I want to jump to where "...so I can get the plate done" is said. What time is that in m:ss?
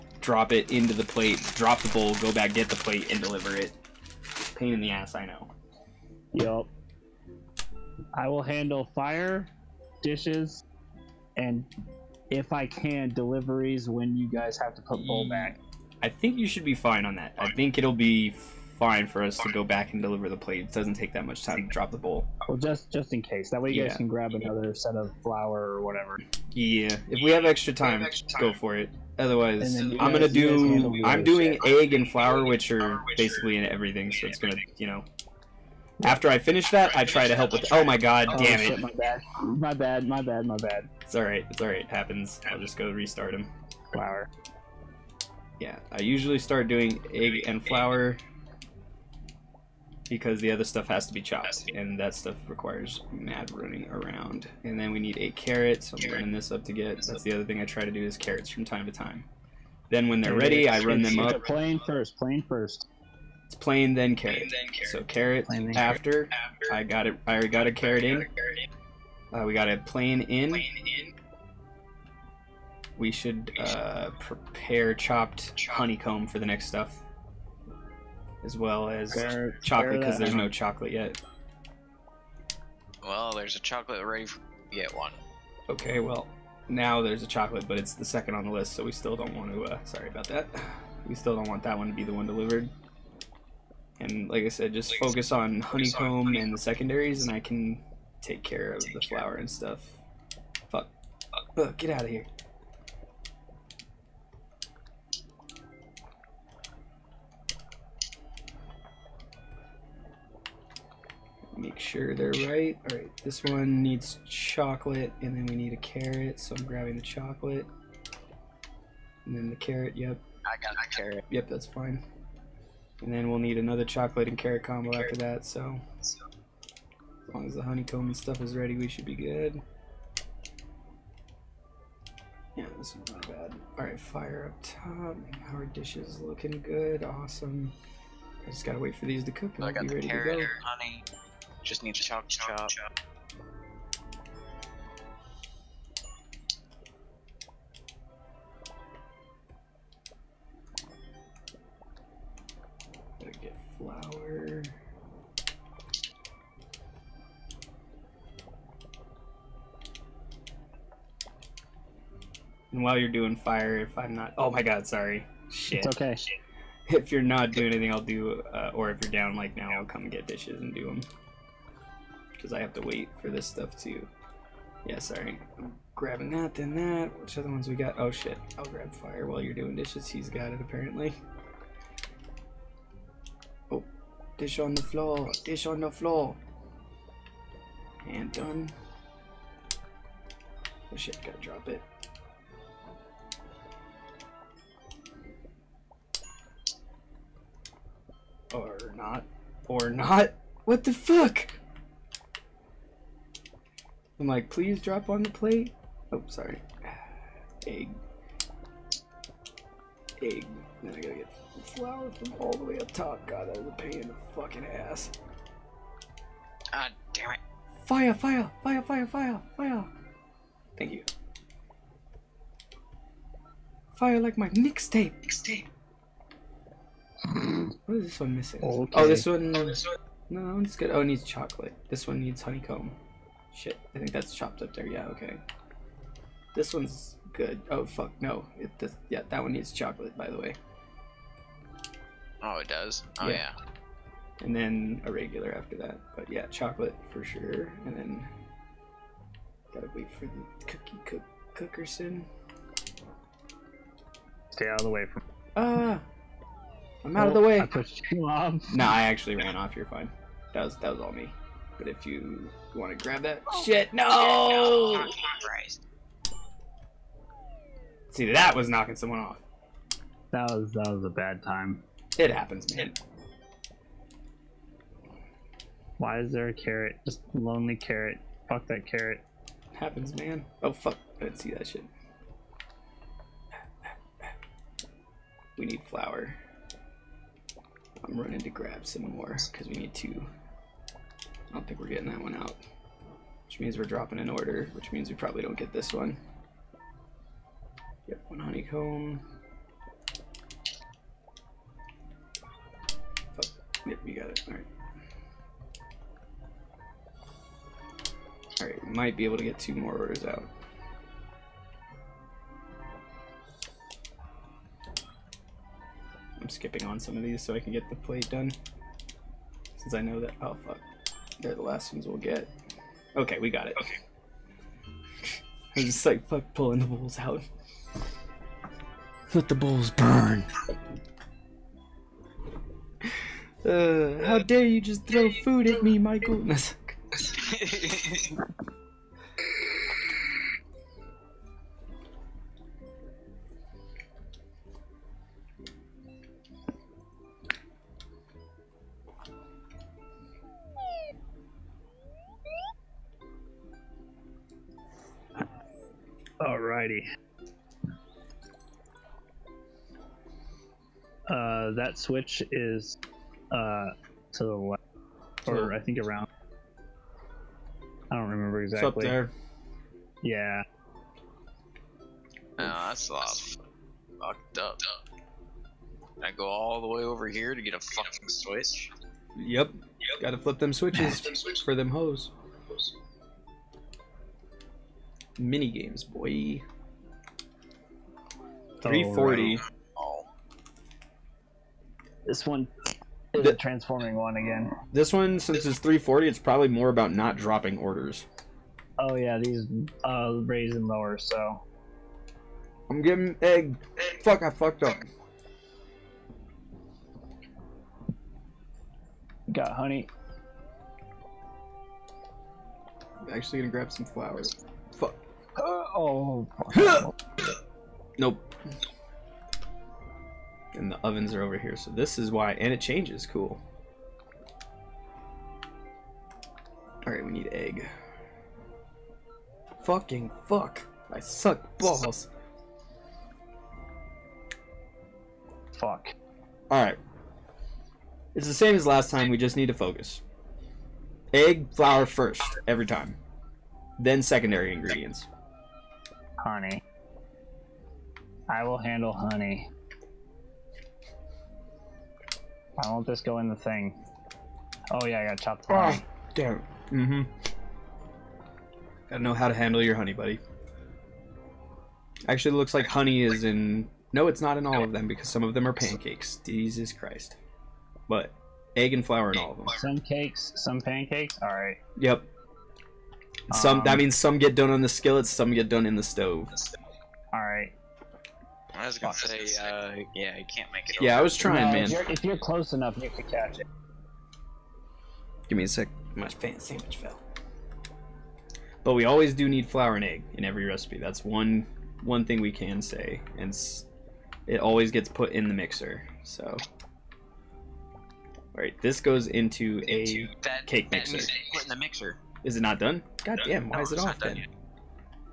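5:17.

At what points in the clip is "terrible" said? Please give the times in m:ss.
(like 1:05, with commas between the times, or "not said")
not said.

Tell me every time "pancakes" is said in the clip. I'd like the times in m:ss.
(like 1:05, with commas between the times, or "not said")
7:45, 7:50.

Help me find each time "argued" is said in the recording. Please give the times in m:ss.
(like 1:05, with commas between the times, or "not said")
not said.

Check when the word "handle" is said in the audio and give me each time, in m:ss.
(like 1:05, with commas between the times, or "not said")
0:08, 7:28, 7:39.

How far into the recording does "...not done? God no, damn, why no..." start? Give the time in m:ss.
8:22.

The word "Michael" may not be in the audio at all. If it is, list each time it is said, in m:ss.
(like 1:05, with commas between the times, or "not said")
5:35.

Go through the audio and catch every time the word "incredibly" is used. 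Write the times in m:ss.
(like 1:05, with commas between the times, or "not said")
not said.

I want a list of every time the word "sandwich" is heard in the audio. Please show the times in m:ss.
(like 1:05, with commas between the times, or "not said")
8:06.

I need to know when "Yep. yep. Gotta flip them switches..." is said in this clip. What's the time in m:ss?
6:19.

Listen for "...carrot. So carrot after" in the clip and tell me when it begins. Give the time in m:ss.
1:04.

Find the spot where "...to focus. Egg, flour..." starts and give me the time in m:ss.
7:19.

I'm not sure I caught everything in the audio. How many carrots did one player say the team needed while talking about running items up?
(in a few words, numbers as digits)
8.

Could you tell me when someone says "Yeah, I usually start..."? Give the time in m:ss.
0:45.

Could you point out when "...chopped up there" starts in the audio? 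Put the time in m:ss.
3:54.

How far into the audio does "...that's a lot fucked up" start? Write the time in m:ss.
6:12.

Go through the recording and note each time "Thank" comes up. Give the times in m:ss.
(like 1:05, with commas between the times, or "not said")
3:40.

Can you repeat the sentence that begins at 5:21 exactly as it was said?
They're the last ones we'll get.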